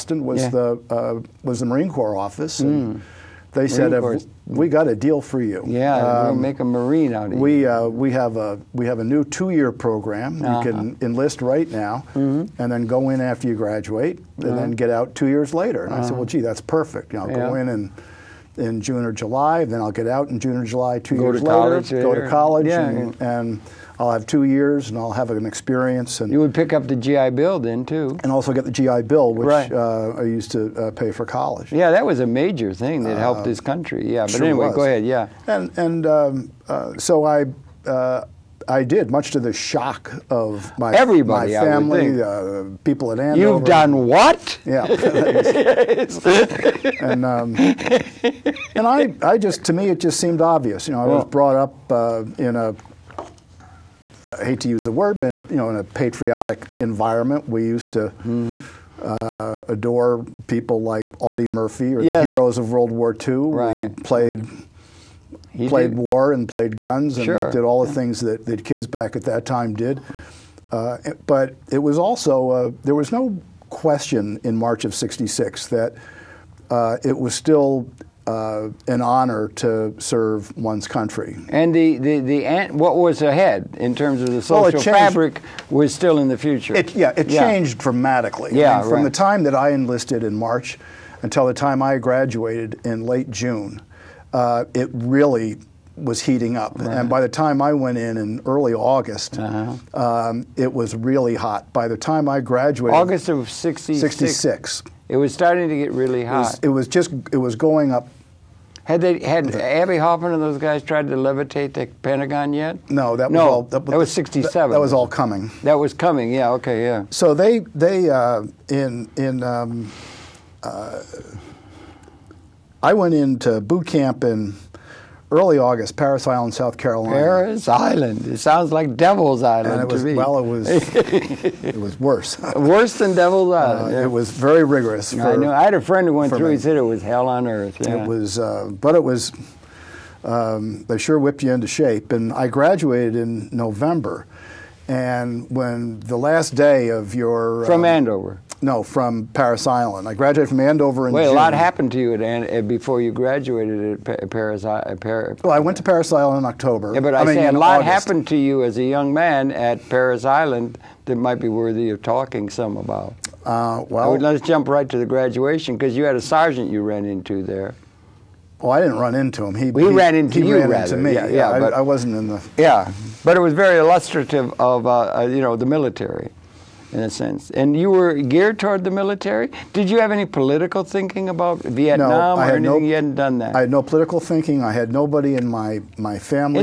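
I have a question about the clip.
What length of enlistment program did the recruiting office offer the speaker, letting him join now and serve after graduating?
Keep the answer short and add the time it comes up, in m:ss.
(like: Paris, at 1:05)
two-year, at 0:09.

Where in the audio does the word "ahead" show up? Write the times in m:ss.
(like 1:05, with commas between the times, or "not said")
0:34, 1:23.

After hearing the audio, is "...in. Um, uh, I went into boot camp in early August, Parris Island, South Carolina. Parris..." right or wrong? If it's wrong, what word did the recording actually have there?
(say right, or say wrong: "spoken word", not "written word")
right.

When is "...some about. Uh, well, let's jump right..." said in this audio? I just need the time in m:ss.
2:42.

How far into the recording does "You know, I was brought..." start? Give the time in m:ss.
0:50.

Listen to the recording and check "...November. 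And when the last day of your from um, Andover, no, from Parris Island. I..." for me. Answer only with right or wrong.
right.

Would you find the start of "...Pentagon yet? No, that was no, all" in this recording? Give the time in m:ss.
1:52.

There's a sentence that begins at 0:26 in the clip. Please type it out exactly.
And you would pick up the GI Bill then too, and also get the GI Bill, which right.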